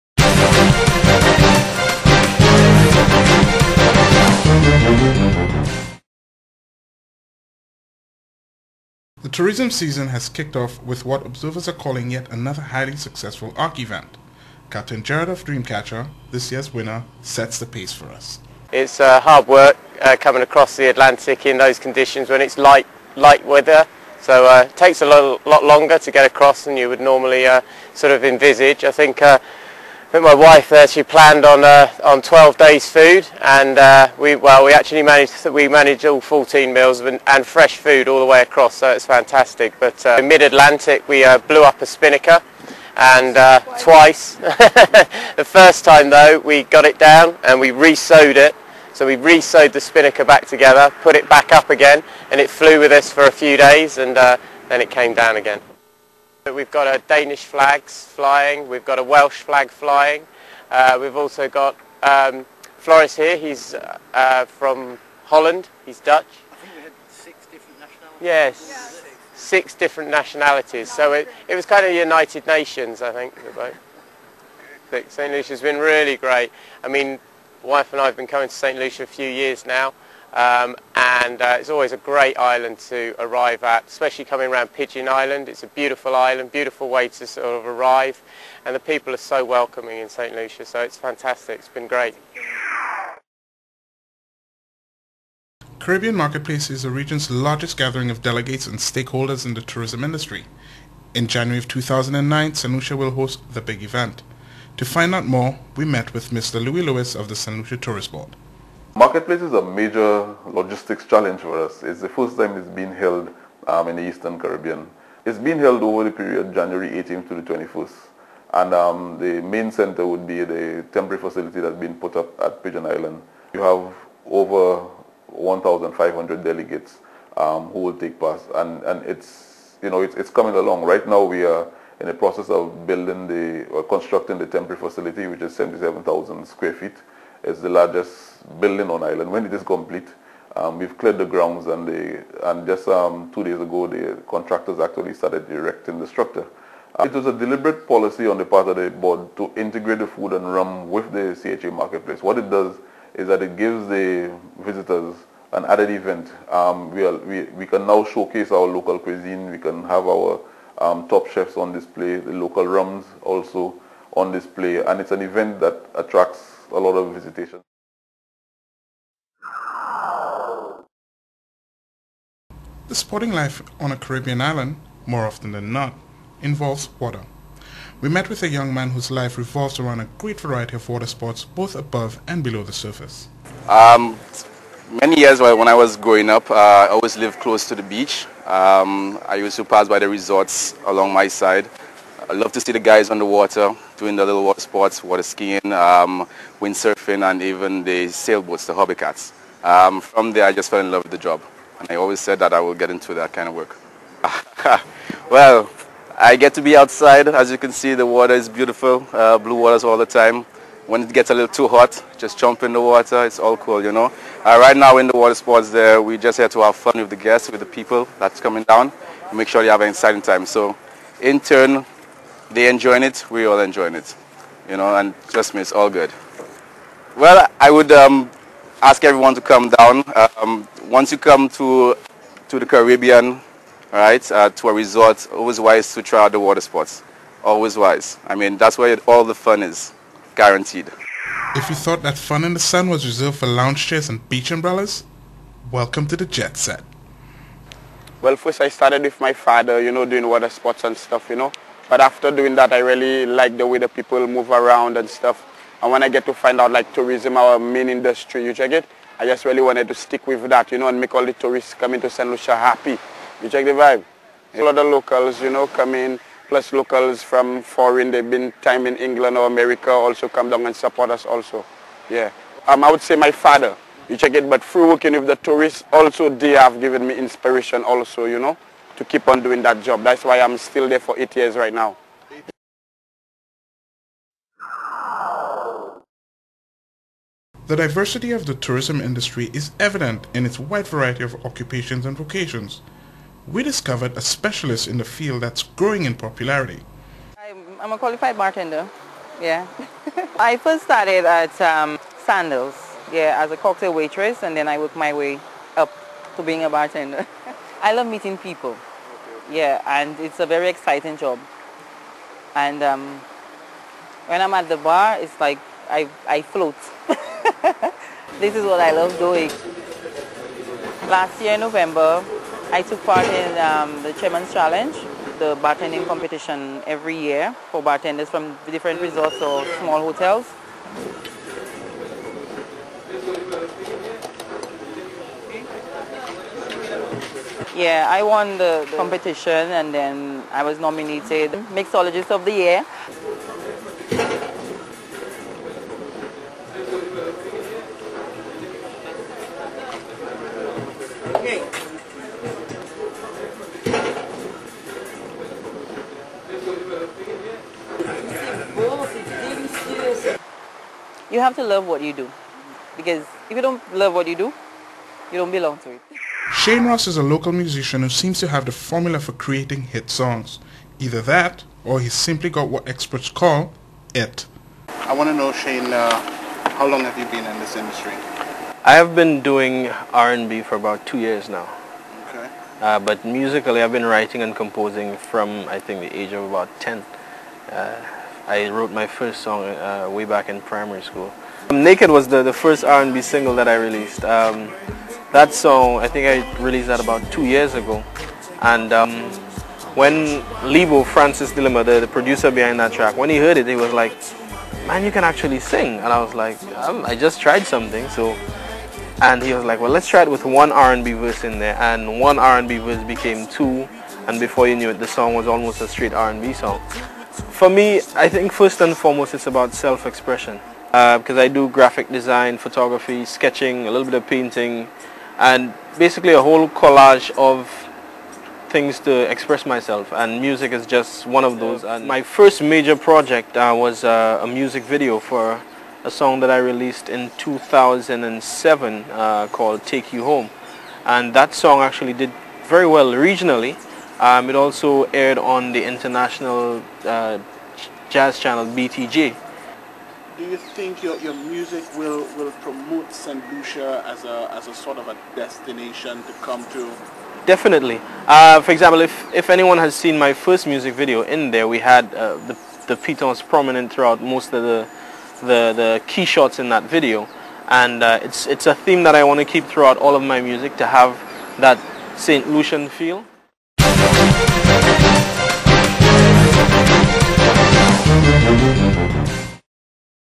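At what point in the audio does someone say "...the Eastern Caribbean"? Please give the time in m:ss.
1:53.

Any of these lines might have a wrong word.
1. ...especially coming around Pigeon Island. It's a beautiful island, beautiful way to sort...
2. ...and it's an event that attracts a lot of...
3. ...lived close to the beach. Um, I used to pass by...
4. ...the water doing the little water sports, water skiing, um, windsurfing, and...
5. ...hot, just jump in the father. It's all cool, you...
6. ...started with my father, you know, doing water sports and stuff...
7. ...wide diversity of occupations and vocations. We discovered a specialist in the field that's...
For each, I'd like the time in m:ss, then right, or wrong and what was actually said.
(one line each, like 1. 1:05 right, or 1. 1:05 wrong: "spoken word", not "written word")
1. 1:23 right
2. 2:44 right
3. 3:07 right
4. 3:13 right
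5. 3:31 wrong: "water", not "father"
6. 4:08 right
7. 4:50 wrong: "variety", not "diversity".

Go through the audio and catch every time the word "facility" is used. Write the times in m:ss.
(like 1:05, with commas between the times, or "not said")
2:01, 2:14.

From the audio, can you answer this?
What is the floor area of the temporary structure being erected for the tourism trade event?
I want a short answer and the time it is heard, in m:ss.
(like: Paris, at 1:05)
77,000 square feet, at 2:15.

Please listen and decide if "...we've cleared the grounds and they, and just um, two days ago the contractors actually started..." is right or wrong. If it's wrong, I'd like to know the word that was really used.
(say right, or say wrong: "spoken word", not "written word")
right.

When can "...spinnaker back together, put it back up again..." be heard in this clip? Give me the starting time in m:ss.
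0:49.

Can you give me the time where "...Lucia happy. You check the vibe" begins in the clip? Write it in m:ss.
4:22.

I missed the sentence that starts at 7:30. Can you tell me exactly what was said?
Do you think your, your music will, will promote St.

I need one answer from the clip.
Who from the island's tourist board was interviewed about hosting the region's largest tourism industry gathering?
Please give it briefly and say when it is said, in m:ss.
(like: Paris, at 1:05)
Louis Lewis, at 1:46.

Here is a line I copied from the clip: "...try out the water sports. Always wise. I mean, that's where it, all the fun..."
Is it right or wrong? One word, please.
right.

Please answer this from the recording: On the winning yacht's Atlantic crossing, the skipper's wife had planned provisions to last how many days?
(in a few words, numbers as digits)
12.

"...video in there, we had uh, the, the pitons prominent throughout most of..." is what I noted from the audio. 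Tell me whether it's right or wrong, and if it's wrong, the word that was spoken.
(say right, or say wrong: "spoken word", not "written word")
right.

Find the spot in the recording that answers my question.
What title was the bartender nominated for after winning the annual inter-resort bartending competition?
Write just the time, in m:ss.
5:41.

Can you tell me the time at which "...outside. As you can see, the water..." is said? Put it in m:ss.
3:26.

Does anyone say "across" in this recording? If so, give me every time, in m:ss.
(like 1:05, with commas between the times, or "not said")
0:20, 0:26, 0:38.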